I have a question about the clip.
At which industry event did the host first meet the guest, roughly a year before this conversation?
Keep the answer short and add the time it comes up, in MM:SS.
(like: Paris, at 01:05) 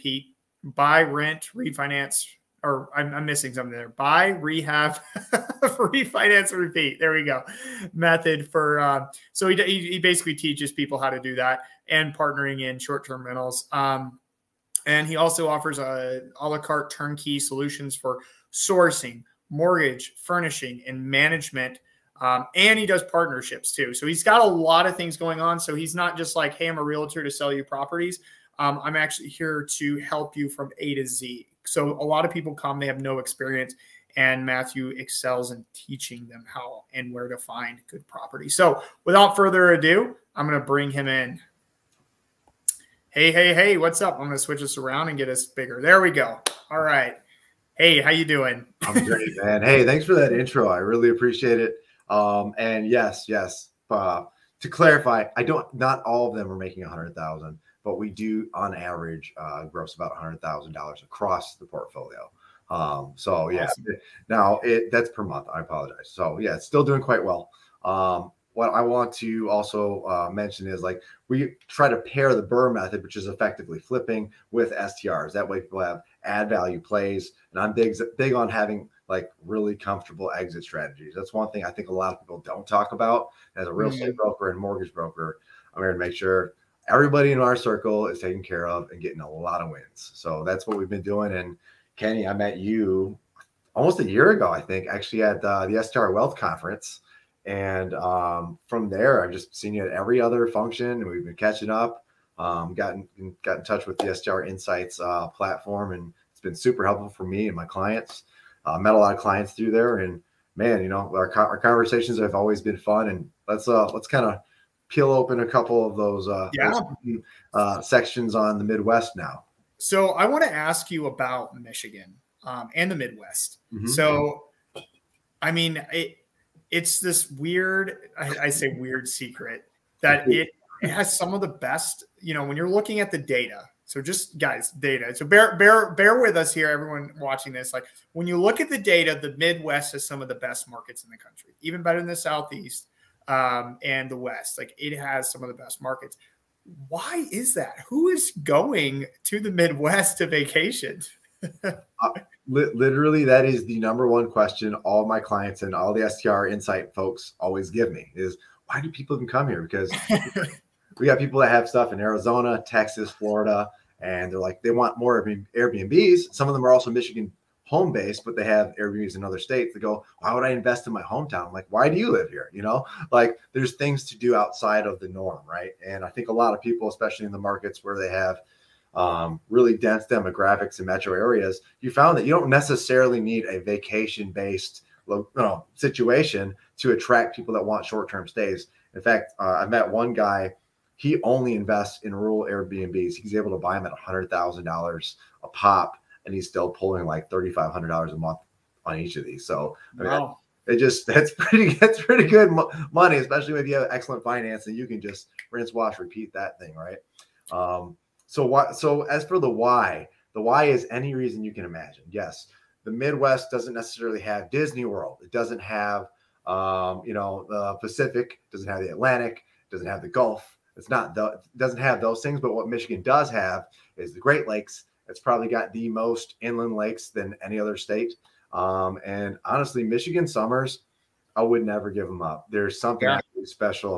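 STR Wealth Conference, at 01:35.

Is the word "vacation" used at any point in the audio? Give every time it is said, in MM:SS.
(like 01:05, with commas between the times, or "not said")
02:30, 03:03.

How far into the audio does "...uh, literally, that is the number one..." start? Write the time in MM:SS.
02:31.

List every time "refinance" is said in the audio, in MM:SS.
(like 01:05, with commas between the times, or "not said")
00:01, 00:05.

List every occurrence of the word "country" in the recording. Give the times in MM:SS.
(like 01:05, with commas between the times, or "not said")
02:21.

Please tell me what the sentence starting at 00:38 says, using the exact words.
So without further ado, I'm going to bring him in.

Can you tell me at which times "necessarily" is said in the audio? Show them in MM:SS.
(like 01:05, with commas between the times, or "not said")
03:02, 03:33.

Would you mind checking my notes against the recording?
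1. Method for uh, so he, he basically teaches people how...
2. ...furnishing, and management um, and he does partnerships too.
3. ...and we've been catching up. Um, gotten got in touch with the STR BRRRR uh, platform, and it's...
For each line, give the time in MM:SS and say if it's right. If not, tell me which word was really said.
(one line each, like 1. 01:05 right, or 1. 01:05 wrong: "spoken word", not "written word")
1. 00:07 right
2. 00:20 right
3. 01:40 wrong: "Insights", not "BRRRR".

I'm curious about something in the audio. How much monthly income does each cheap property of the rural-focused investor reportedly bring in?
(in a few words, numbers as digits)
$3,500.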